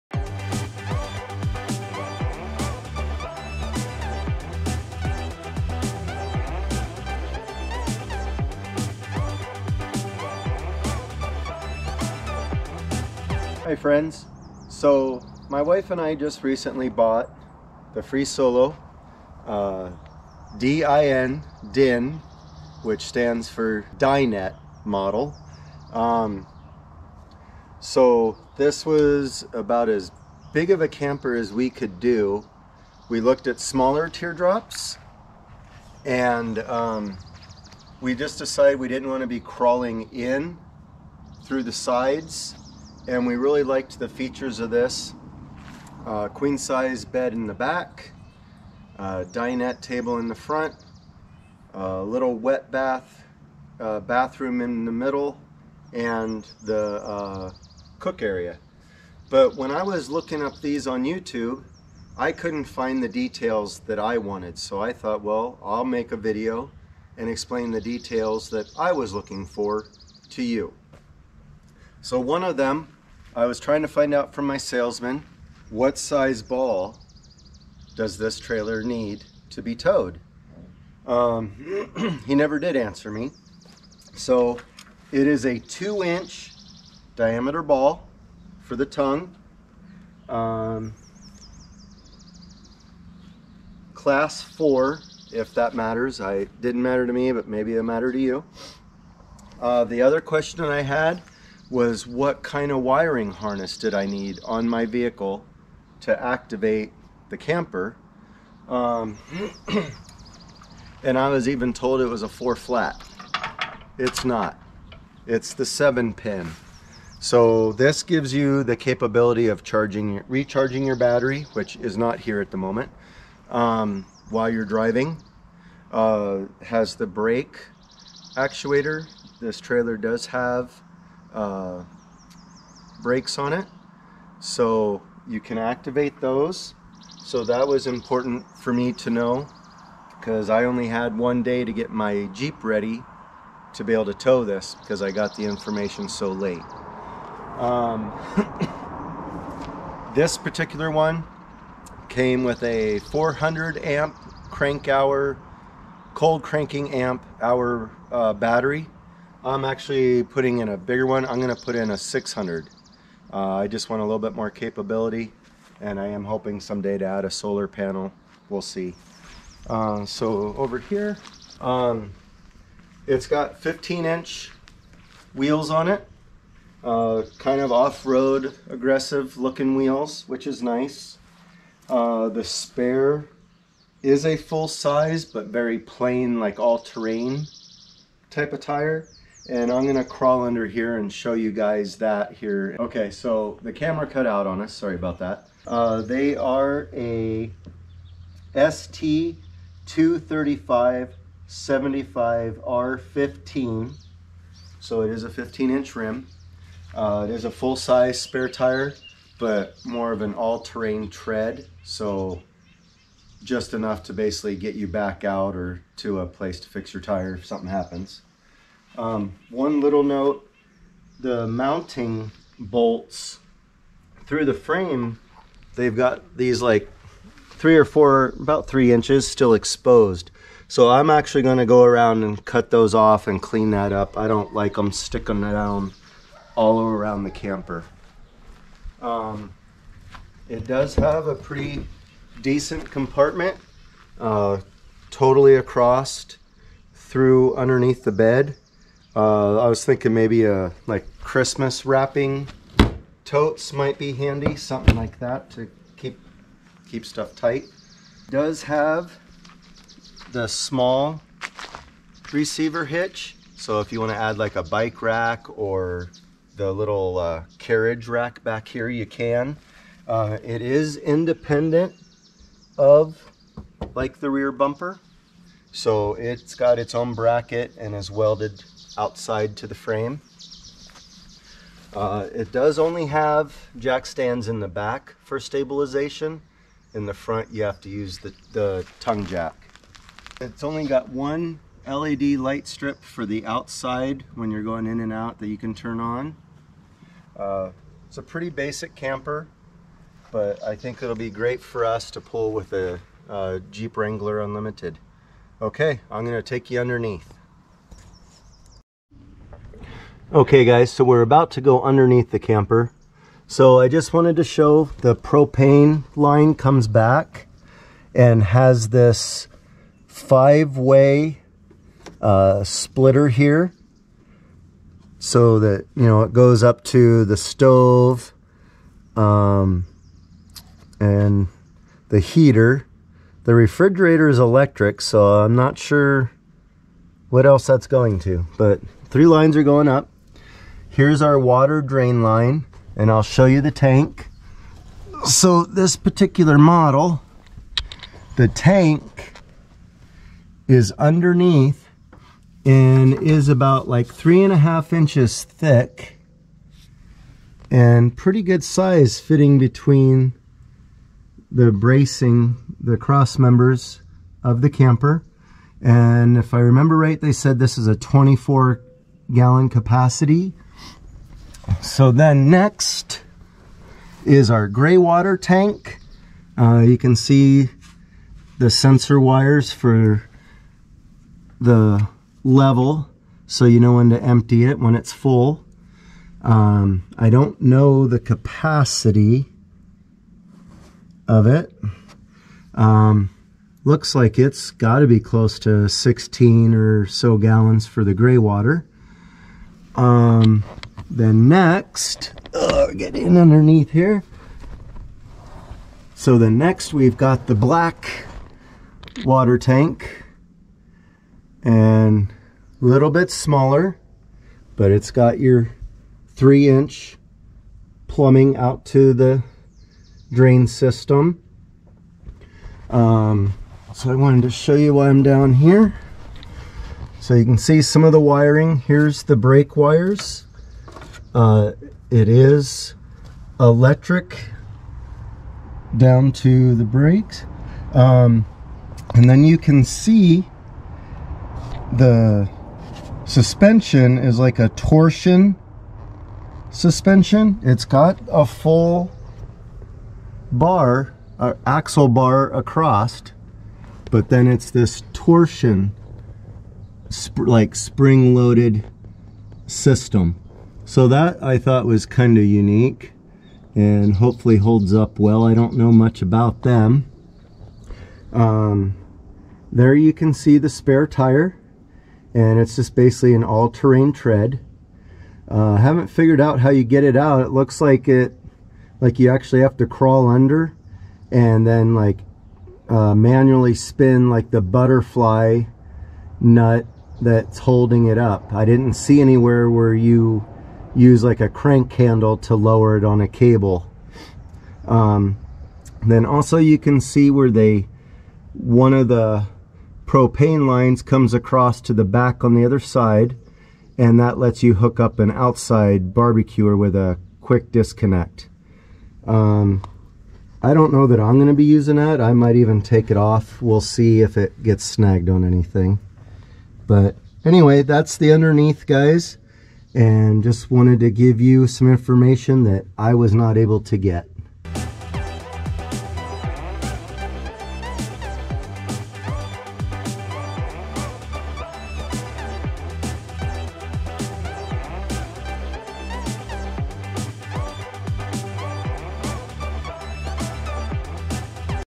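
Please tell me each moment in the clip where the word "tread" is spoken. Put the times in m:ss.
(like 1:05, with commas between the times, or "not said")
3:31, 7:54.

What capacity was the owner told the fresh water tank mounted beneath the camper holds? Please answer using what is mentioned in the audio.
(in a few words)
24 gallons.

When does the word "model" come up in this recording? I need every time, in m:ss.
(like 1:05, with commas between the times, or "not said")
0:24, 5:46.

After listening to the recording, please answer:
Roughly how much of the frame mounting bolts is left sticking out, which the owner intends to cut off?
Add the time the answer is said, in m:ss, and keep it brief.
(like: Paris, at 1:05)
3 inches, at 3:48.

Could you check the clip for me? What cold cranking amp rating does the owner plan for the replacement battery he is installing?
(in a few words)
600.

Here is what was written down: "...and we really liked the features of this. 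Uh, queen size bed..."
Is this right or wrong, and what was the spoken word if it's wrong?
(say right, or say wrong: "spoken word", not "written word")
right.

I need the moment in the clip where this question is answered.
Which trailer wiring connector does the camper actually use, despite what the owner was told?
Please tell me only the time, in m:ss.
1:55.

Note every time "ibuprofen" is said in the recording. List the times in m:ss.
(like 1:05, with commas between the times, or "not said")
not said.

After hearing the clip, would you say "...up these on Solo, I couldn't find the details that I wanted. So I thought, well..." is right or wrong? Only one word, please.
wrong.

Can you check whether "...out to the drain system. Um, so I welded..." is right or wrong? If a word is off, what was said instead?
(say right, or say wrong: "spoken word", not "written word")
wrong: "wanted", not "welded".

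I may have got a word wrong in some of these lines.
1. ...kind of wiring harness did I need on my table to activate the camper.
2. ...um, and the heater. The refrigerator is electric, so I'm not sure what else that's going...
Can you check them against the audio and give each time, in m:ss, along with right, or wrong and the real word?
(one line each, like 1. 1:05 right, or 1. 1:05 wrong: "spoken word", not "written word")
1. 1:42 wrong: "vehicle", not "table"
2. 5:29 right.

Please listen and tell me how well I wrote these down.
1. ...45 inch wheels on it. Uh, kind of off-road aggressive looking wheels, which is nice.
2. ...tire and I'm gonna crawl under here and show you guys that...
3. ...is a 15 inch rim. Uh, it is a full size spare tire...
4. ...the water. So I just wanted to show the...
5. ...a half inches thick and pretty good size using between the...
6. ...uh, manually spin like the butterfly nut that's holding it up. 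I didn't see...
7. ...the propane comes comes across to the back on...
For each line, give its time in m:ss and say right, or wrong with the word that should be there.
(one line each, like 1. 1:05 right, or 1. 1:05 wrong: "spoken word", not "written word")
1. 2:53 wrong: "15", not "45"
2. 3:08 right
3. 3:25 right
4. 5:12 wrong: "camper", not "water"
5. 5:54 wrong: "fitting", not "using"
6. 8:02 right
7. 8:19 wrong: "lines", not "comes".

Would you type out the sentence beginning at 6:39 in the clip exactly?
Um, then next, oh, get in underneath here.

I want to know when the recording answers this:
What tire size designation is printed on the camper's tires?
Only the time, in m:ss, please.
3:18.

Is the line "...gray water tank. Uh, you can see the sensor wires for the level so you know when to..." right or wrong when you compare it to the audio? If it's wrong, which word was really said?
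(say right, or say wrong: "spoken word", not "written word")
right.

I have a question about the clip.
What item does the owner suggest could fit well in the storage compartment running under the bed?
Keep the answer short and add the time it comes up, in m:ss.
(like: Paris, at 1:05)
Christmas wrapping totes, at 4:11.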